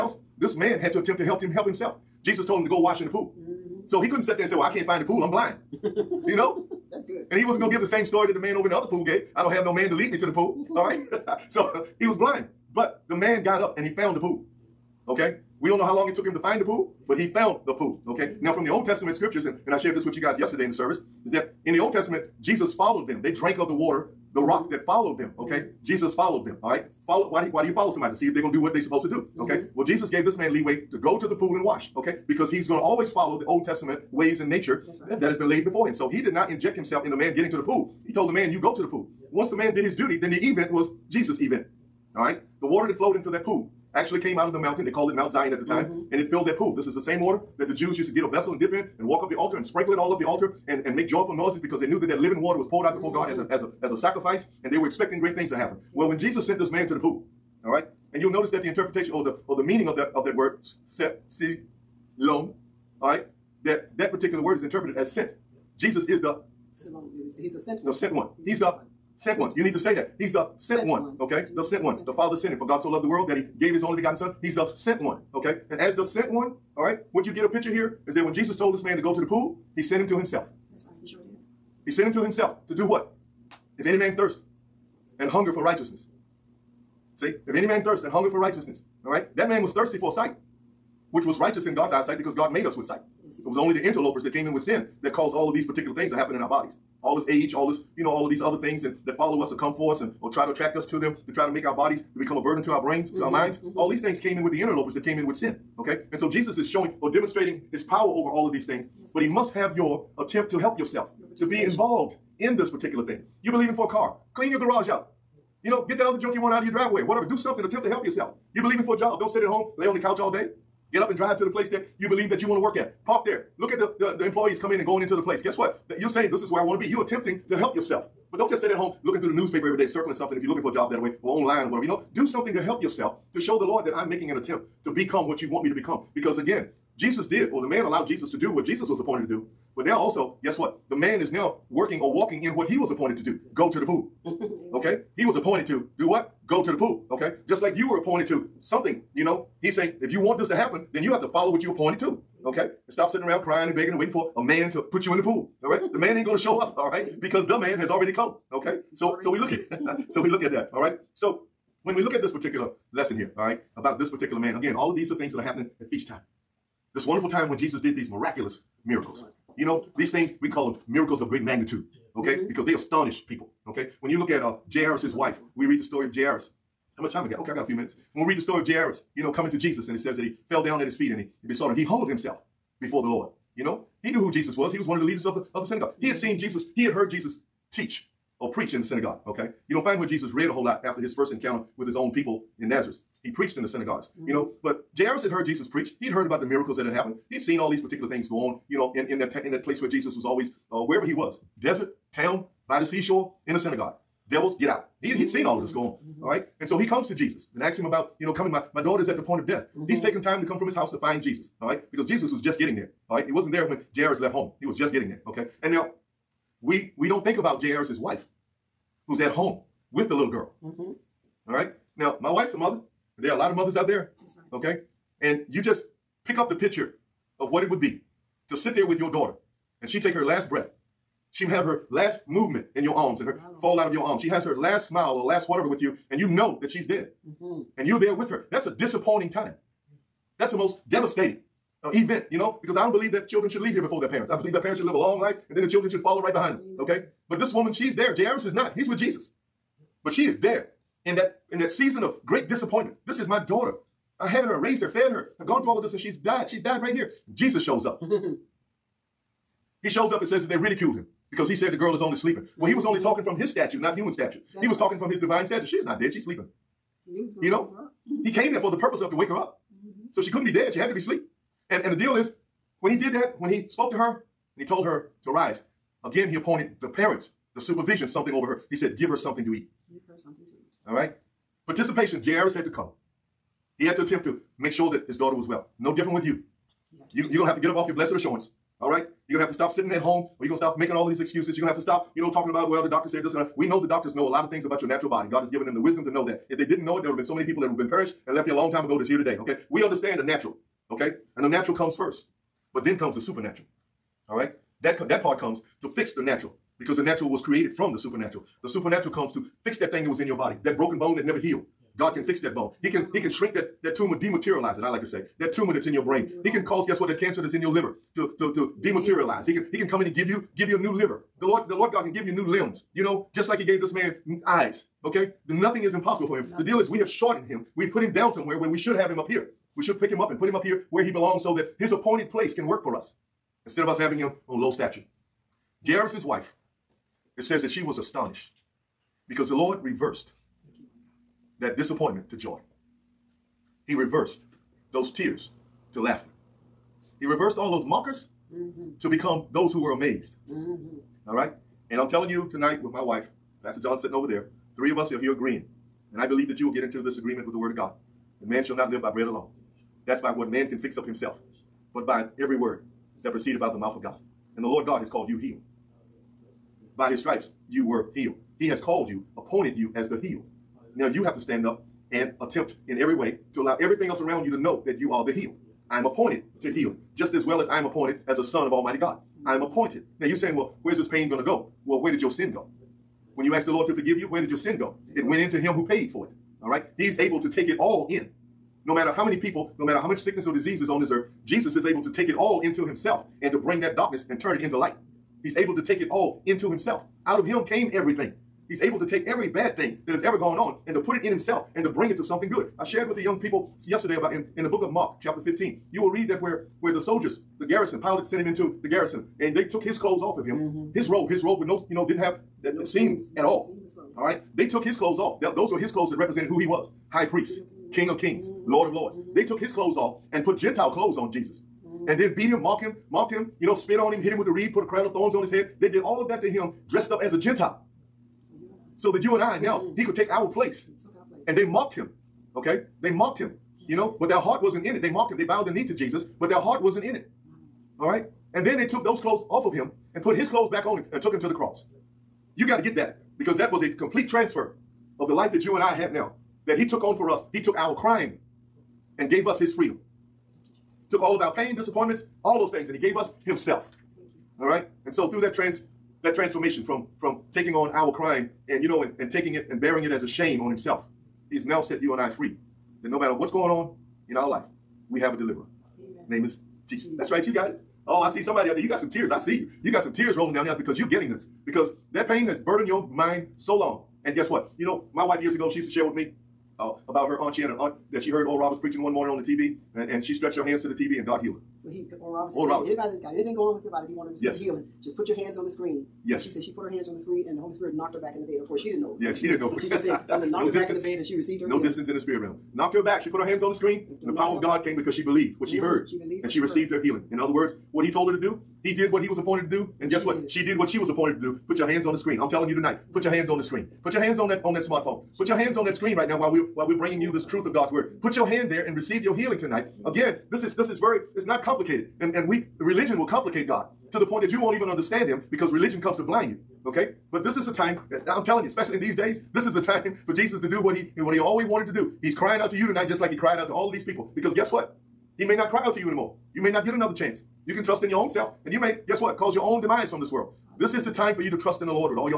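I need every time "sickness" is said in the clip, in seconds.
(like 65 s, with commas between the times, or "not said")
390 s.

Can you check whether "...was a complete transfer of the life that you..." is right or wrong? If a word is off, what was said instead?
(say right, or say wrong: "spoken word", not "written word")
right.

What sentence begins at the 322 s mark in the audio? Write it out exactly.
You know, just like he gave this man eyes, okay?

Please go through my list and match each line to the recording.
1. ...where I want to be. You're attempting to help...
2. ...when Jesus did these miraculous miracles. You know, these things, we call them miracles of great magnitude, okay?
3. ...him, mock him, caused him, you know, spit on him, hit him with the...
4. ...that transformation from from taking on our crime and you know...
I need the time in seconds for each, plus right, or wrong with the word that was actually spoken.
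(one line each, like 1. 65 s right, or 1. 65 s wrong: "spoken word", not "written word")
1. 126 s right
2. 167 s right
3. 422 s wrong: "mocked", not "caused"
4. 456 s right.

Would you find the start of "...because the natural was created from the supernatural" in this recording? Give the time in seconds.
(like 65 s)
306 s.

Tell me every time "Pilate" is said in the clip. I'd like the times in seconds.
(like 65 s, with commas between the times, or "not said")
408 s.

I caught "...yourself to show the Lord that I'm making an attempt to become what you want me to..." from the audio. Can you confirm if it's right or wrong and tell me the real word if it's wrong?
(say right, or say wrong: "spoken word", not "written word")
right.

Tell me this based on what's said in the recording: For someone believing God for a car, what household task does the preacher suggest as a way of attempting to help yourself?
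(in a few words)
Clean your garage.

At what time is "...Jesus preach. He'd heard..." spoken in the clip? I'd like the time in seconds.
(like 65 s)
195 s.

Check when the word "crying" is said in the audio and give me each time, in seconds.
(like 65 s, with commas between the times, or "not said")
153 s, 522 s.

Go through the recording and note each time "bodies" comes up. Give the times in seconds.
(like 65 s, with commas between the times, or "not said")
96 s, 101 s.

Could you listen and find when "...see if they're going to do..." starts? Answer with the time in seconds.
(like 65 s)
28 s.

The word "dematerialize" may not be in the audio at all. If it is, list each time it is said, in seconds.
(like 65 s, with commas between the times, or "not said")
314 s, 318 s.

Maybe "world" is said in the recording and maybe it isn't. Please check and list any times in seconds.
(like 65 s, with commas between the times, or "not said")
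73 s, 530 s.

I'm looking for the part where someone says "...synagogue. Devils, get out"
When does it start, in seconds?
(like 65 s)
203 s.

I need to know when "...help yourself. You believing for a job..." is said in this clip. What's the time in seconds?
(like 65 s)
117 s.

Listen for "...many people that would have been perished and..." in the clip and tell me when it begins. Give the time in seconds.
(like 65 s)
297 s.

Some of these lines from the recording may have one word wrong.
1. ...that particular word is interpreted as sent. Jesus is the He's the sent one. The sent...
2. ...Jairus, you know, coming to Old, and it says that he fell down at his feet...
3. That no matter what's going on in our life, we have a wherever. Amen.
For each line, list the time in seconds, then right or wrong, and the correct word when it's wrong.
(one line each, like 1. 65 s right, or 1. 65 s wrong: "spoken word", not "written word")
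1. 63 s right
2. 178 s wrong: "Jesus", not "Old"
3. 463 s wrong: "deliverer", not "wherever".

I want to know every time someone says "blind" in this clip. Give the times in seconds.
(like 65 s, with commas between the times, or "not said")
5 s, 12 s, 516 s.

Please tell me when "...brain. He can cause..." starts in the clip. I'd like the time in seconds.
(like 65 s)
316 s.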